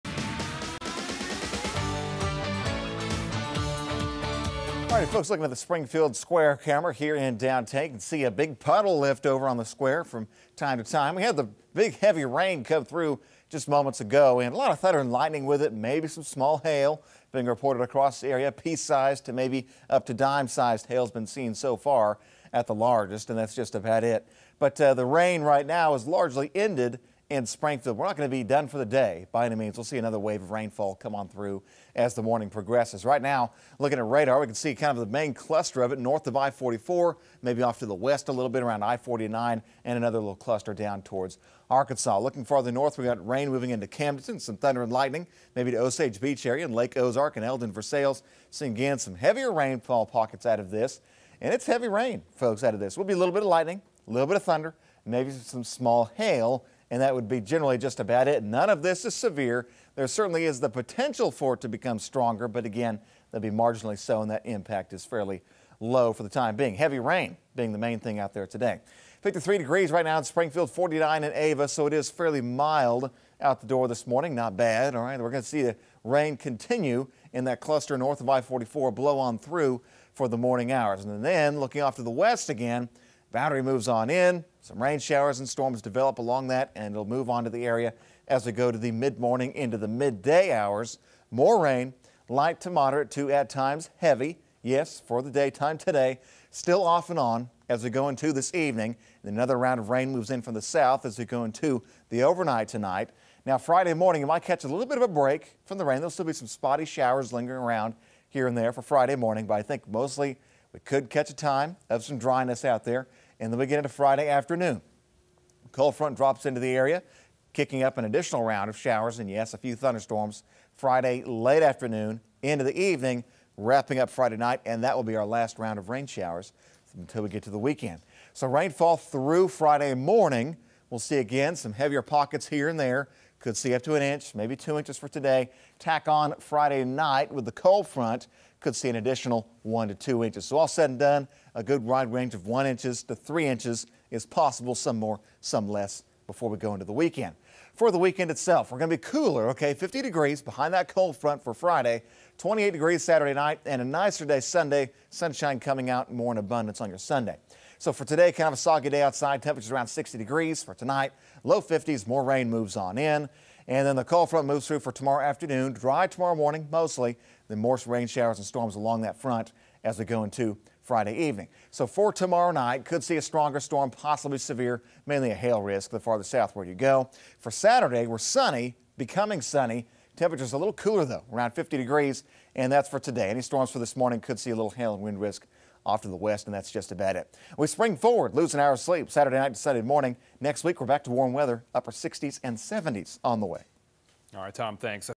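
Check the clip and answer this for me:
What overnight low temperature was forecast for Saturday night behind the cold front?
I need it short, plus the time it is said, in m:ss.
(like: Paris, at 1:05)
28 degrees, at 2:32.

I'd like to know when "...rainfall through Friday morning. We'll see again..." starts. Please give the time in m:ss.
2:08.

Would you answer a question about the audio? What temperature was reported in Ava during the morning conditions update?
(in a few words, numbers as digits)
49.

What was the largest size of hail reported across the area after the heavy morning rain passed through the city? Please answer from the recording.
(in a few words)
dime-sized.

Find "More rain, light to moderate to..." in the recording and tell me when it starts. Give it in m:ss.
1:31.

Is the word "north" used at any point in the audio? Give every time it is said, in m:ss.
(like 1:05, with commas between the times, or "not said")
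0:35, 0:42, 1:17.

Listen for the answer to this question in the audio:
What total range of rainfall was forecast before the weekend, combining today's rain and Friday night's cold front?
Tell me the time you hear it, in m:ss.
2:22.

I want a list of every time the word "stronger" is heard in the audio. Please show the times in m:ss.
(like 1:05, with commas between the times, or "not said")
1:01, 2:53.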